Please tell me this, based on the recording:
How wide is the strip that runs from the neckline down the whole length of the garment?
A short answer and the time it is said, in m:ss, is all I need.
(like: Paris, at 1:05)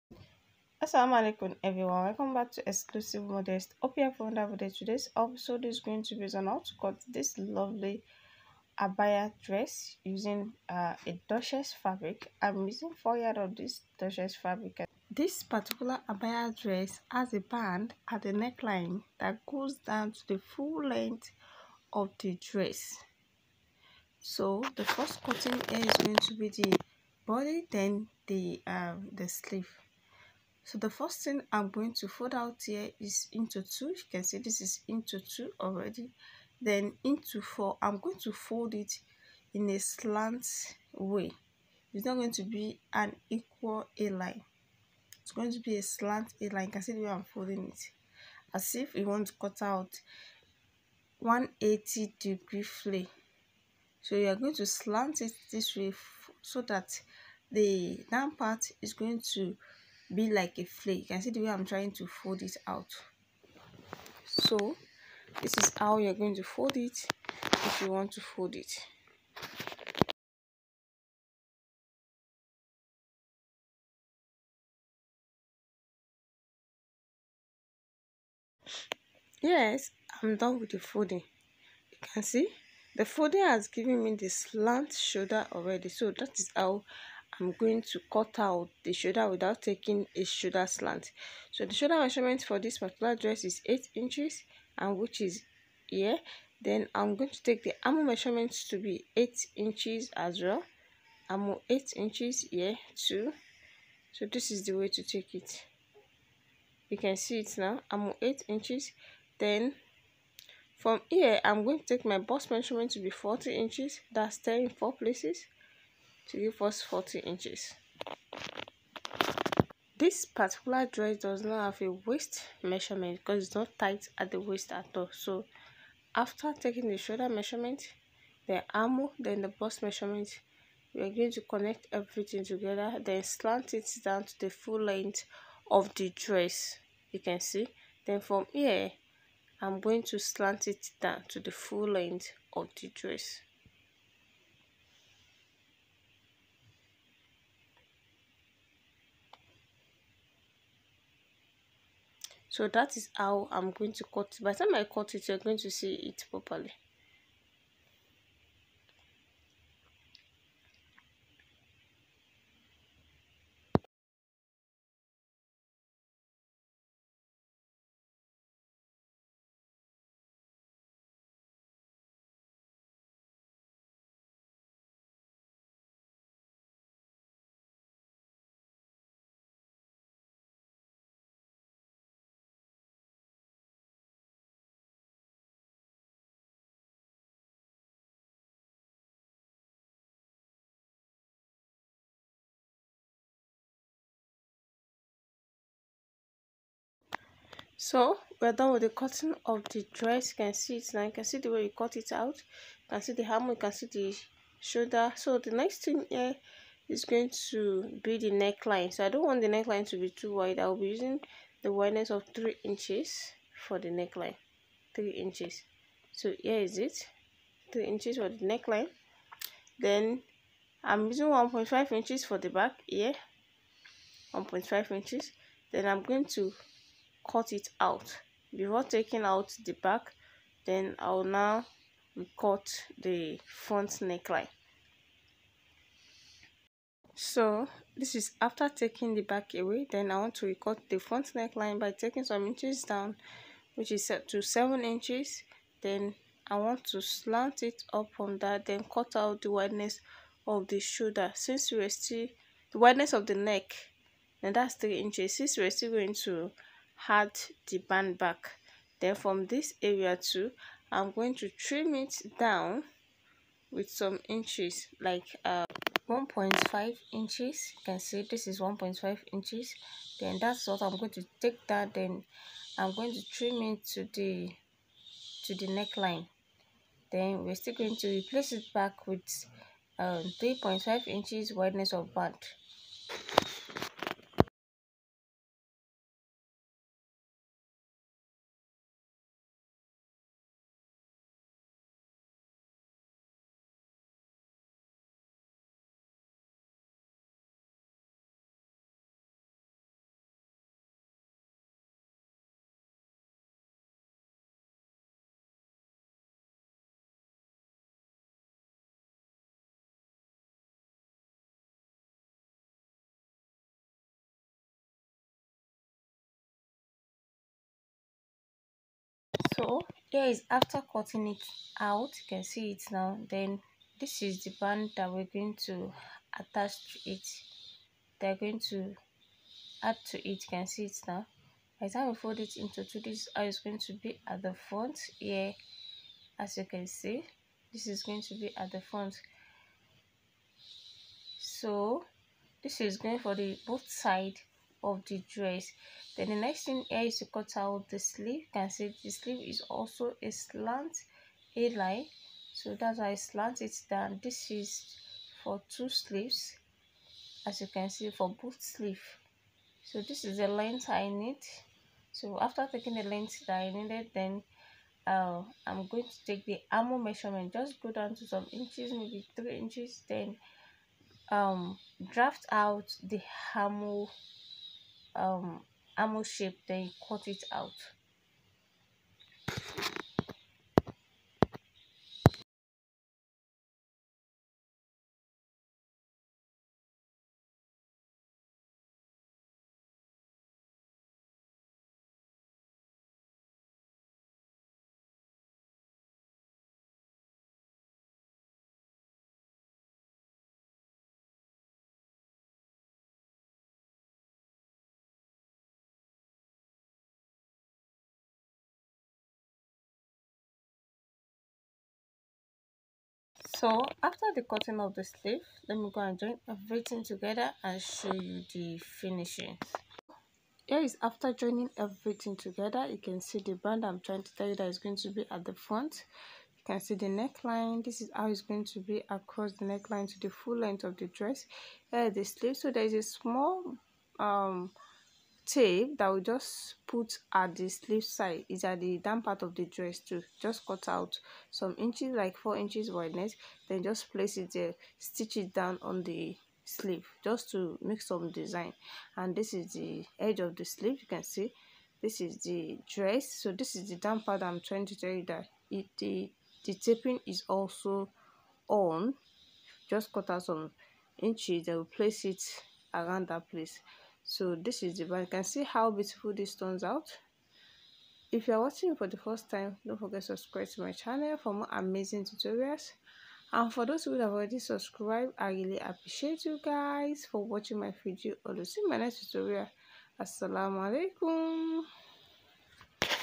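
3.5 inches, at 4:40.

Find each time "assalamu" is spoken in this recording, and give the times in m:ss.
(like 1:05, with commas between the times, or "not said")
0:00, 8:00.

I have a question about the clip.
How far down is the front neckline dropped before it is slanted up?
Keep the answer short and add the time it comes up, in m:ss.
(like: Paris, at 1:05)
7 inches, at 4:04.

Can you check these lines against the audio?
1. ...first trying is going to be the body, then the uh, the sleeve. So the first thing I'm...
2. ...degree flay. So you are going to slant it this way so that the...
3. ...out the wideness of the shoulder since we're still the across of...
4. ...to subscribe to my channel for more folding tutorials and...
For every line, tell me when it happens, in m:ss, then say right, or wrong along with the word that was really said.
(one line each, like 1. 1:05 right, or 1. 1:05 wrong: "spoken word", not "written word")
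1. 0:24 wrong: "cutting", not "trying"
2. 0:52 right
3. 4:09 wrong: "wideness", not "across"
4. 7:50 wrong: "amazing", not "folding".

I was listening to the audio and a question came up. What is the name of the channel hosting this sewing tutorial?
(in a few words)
Xclusive Modest.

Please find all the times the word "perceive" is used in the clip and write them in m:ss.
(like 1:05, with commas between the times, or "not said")
not said.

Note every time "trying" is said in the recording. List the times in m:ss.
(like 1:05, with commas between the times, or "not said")
1:01, 7:03, 7:34.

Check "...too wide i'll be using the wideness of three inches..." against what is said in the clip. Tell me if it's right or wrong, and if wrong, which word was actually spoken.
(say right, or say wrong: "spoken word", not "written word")
right.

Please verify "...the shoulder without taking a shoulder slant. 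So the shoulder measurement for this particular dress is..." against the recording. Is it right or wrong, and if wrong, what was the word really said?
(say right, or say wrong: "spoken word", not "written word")
right.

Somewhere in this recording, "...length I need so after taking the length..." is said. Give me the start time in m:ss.
6:00.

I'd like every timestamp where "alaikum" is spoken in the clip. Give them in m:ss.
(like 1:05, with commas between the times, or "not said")
0:01, 8:00.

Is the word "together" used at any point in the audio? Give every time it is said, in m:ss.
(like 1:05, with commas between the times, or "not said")
2:12, 6:57, 7:02.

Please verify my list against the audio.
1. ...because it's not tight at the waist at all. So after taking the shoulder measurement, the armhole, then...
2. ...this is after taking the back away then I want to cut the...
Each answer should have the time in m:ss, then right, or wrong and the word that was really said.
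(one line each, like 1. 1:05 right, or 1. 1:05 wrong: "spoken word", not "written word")
1. 2:03 right
2. 3:57 right.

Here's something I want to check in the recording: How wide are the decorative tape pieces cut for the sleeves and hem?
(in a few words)
4 inches.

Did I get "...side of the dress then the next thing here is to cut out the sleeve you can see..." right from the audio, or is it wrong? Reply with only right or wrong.
right.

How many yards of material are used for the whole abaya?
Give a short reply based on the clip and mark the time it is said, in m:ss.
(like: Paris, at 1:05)
4 yards, at 0:12.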